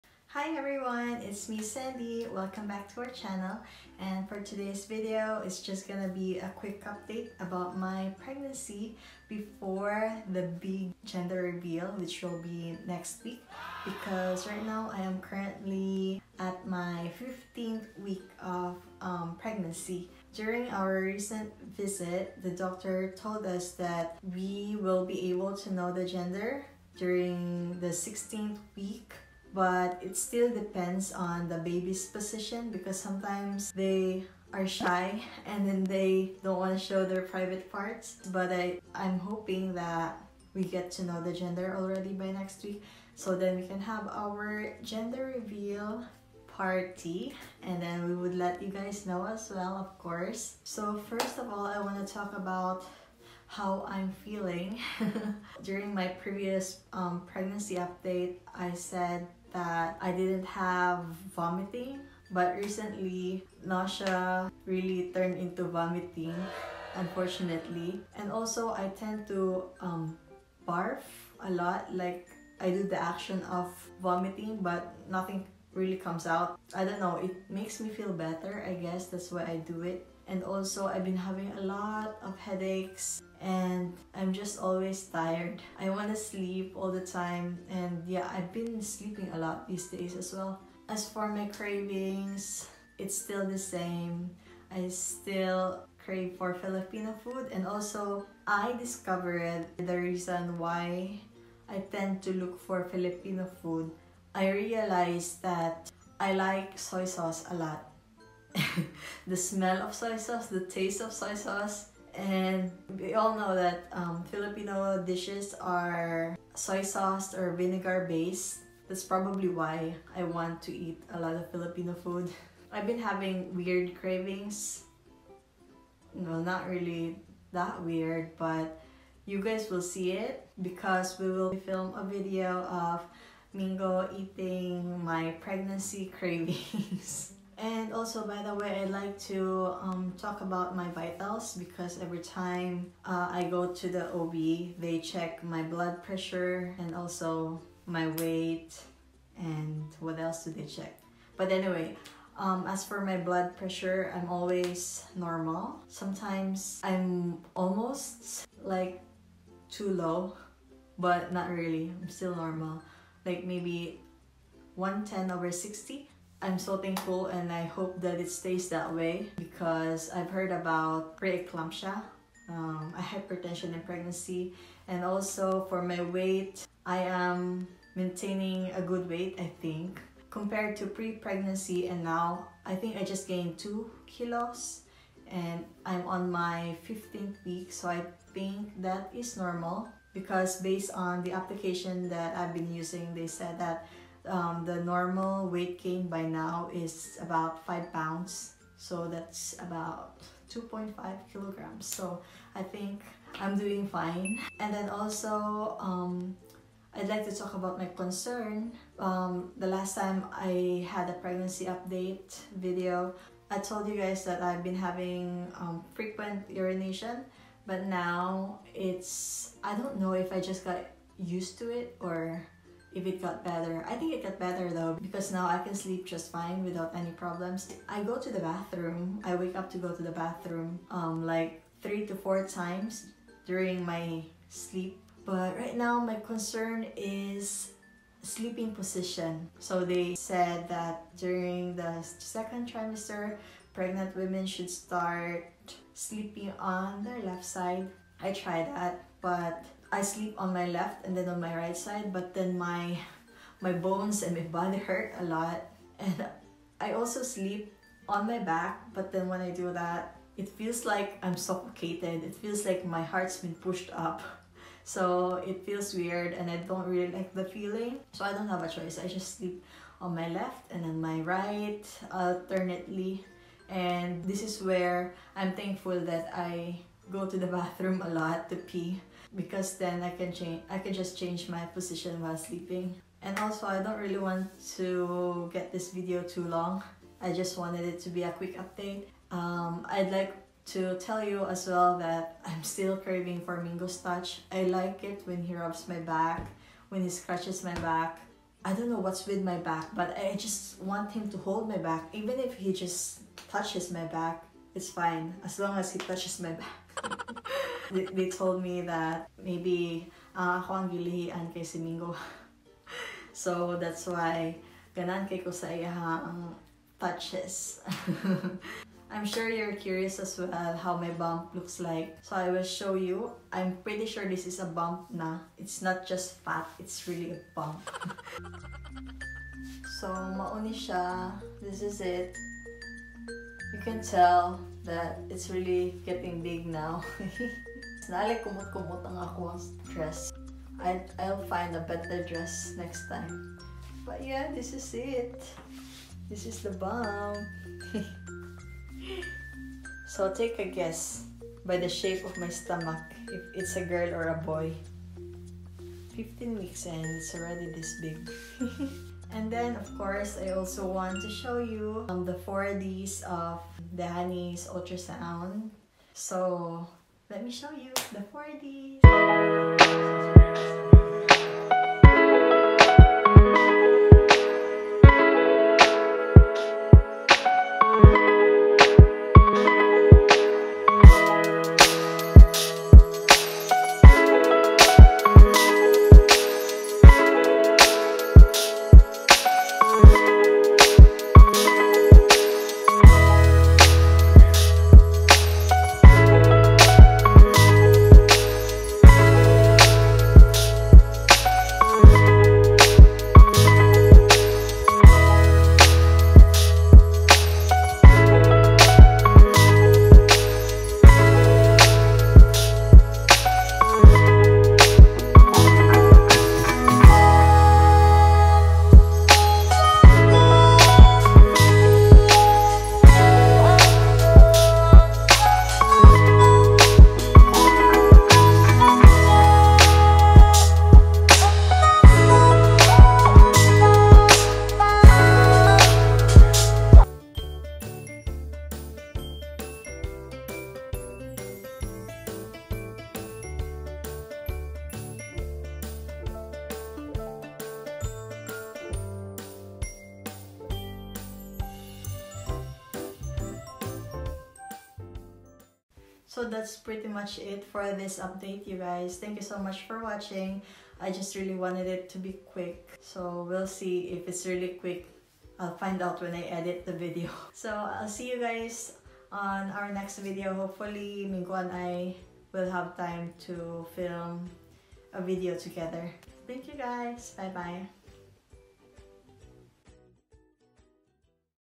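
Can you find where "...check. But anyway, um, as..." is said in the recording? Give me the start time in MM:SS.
02:30.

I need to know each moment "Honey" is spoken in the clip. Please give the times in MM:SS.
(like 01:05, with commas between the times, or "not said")
06:04.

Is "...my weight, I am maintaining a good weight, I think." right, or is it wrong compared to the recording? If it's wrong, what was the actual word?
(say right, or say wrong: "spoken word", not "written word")
right.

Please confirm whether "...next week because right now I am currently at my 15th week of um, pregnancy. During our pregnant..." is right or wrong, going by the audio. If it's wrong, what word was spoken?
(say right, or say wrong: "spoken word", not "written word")
wrong: "recent", not "pregnant".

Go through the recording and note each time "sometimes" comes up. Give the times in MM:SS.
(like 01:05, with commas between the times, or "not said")
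00:32, 02:35.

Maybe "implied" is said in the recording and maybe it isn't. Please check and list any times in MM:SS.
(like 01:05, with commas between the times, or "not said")
not said.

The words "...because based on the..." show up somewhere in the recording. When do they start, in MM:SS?
03:10.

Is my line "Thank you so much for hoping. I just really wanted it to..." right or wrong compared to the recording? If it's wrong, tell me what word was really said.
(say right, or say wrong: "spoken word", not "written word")
wrong: "watching", not "hoping".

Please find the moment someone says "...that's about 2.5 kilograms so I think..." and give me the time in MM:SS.
03:19.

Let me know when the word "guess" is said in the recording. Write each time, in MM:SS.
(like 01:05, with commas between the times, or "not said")
01:18, 05:50.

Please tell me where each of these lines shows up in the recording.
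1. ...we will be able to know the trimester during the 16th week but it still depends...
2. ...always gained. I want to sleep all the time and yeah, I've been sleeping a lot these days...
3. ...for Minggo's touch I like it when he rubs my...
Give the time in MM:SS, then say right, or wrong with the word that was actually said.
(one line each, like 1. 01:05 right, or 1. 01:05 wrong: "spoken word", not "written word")
1. 00:24 wrong: "gender", not "trimester"
2. 01:24 wrong: "tired", not "gained"
3. 04:53 right.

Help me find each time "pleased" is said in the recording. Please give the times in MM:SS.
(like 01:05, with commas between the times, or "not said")
not said.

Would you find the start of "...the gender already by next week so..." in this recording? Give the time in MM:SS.
00:41.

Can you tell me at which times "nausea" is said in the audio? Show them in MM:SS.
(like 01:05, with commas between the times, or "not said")
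01:03.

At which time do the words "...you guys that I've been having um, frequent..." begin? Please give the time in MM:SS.
03:33.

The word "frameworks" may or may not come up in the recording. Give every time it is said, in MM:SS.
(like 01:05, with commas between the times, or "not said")
not said.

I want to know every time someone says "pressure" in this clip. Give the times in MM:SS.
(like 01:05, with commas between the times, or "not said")
02:26, 02:33.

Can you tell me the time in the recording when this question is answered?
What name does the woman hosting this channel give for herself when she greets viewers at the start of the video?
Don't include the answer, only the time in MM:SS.
00:01.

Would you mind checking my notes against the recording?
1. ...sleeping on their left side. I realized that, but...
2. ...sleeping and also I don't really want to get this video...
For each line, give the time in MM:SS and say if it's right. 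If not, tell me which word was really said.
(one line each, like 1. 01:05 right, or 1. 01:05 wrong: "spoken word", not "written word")
1. 04:05 wrong: "tried", not "realized"
2. 04:42 right.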